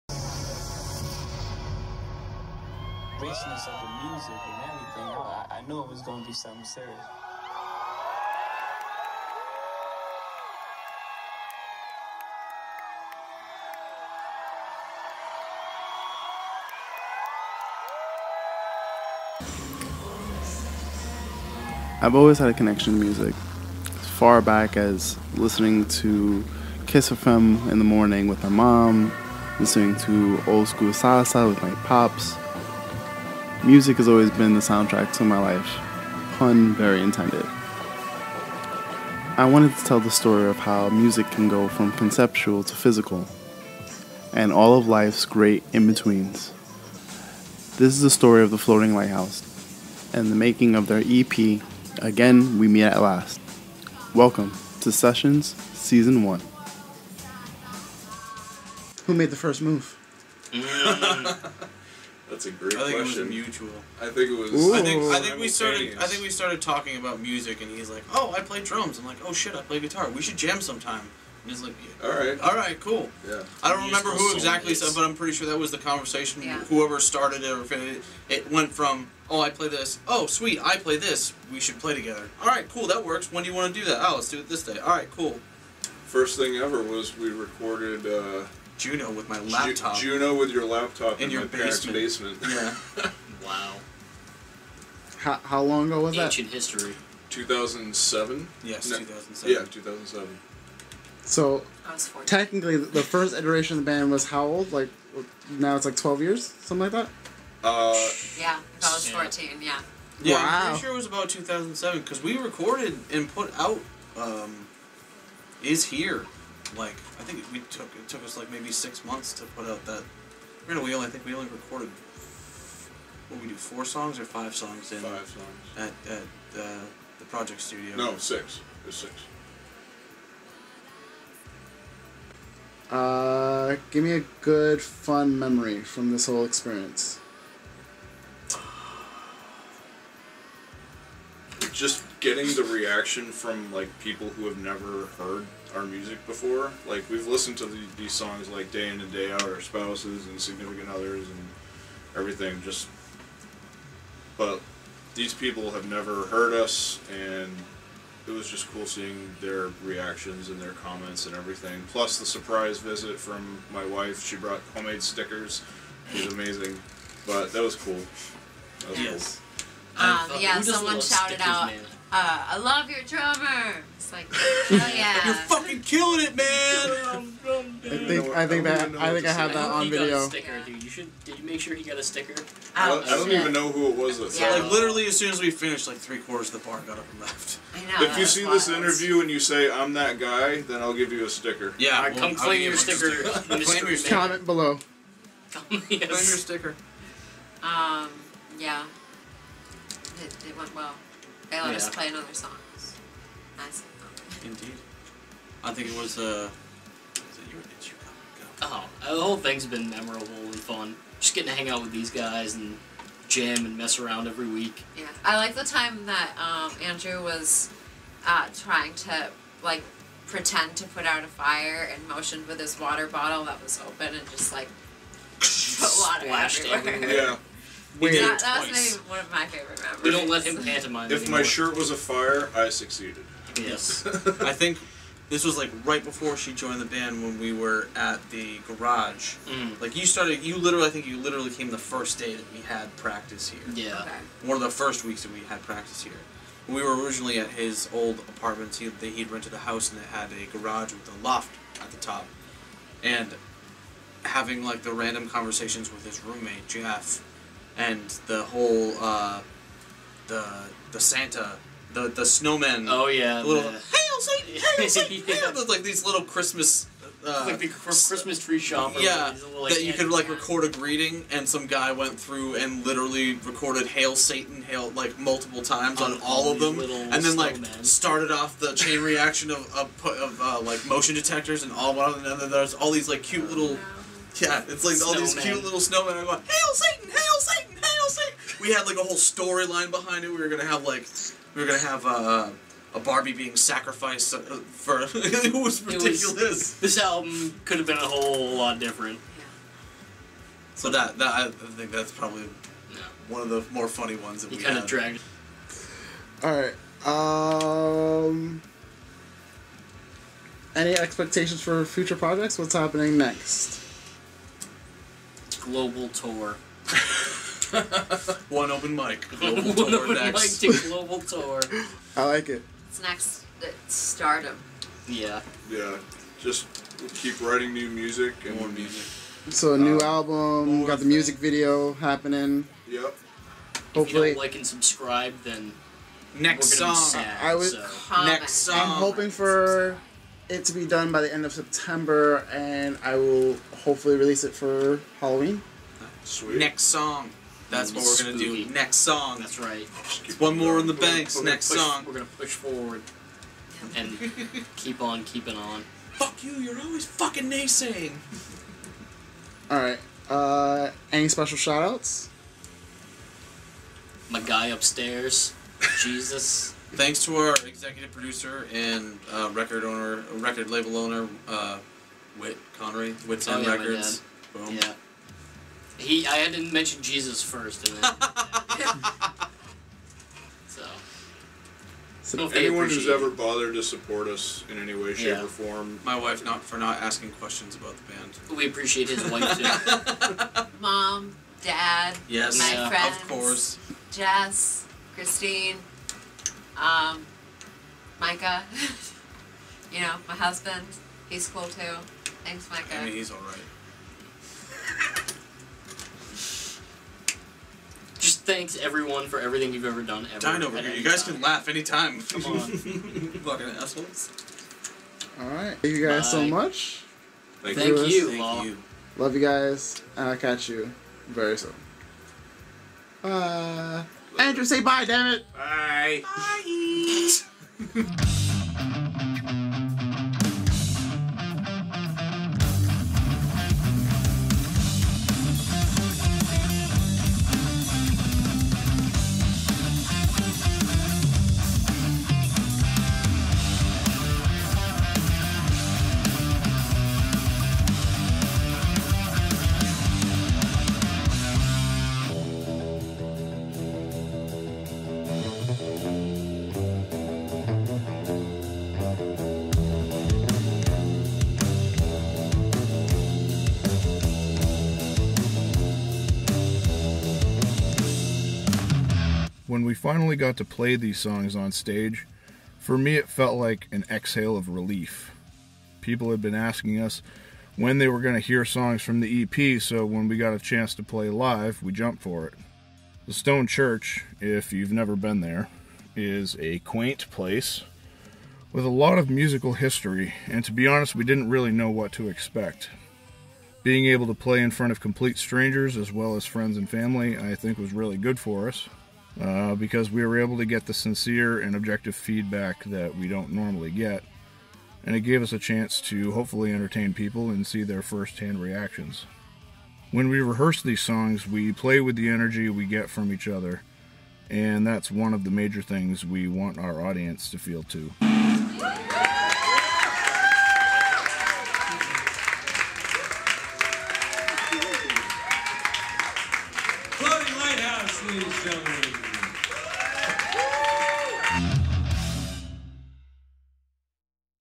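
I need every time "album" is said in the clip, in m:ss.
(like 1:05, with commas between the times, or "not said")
4:56, 5:30.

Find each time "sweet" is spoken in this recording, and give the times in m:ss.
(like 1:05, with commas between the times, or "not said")
1:20, 5:46.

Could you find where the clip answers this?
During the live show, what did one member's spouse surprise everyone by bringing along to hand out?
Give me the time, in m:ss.
2:44.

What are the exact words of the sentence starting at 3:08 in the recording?
this interview and you say I'm that guy, then I'll give you a sticker.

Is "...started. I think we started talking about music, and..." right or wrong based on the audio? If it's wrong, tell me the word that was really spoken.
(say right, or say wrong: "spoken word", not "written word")
right.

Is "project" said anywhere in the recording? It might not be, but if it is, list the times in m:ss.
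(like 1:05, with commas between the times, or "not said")
2:07, 5:12.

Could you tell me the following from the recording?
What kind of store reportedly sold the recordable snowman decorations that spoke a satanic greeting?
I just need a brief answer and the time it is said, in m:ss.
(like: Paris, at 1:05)
Christmas tree shop, at 4:27.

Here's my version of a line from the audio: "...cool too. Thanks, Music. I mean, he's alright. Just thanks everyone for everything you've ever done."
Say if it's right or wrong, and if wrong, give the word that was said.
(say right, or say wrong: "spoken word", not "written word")
wrong: "Micah", not "Music".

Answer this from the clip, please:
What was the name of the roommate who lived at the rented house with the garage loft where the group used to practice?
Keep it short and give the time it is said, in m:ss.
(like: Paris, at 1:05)
Jeff, at 4:16.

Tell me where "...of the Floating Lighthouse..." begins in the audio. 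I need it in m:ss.
0:48.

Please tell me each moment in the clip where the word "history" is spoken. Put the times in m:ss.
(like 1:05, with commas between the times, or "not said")
1:36, 8:09.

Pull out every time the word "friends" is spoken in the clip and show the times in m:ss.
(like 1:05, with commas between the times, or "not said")
6:32, 8:16.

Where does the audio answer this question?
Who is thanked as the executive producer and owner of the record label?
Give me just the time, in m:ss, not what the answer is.
6:12.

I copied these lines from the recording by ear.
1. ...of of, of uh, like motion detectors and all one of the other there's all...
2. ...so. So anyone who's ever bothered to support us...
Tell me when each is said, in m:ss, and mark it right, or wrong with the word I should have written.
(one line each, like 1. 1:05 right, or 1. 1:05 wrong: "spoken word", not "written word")
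1. 4:39 right
2. 6:20 right.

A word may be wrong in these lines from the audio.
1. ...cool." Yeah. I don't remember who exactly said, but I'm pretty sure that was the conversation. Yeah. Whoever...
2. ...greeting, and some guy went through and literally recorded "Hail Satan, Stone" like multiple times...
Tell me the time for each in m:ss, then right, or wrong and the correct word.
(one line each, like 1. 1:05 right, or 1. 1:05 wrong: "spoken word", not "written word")
1. 1:12 right
2. 4:30 wrong: "Hail", not "Stone".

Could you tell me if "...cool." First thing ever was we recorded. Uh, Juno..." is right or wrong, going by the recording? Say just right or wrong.
right.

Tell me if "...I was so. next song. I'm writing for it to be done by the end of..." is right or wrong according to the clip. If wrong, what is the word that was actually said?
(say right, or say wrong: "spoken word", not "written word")
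wrong: "hoping", not "writing".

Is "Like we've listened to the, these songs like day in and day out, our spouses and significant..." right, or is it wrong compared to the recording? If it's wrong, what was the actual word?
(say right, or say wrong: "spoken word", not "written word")
right.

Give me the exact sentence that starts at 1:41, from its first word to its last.
So, technically, the first iteration of the band was how old?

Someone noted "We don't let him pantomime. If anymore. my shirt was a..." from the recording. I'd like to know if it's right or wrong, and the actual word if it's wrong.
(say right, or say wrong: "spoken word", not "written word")
right.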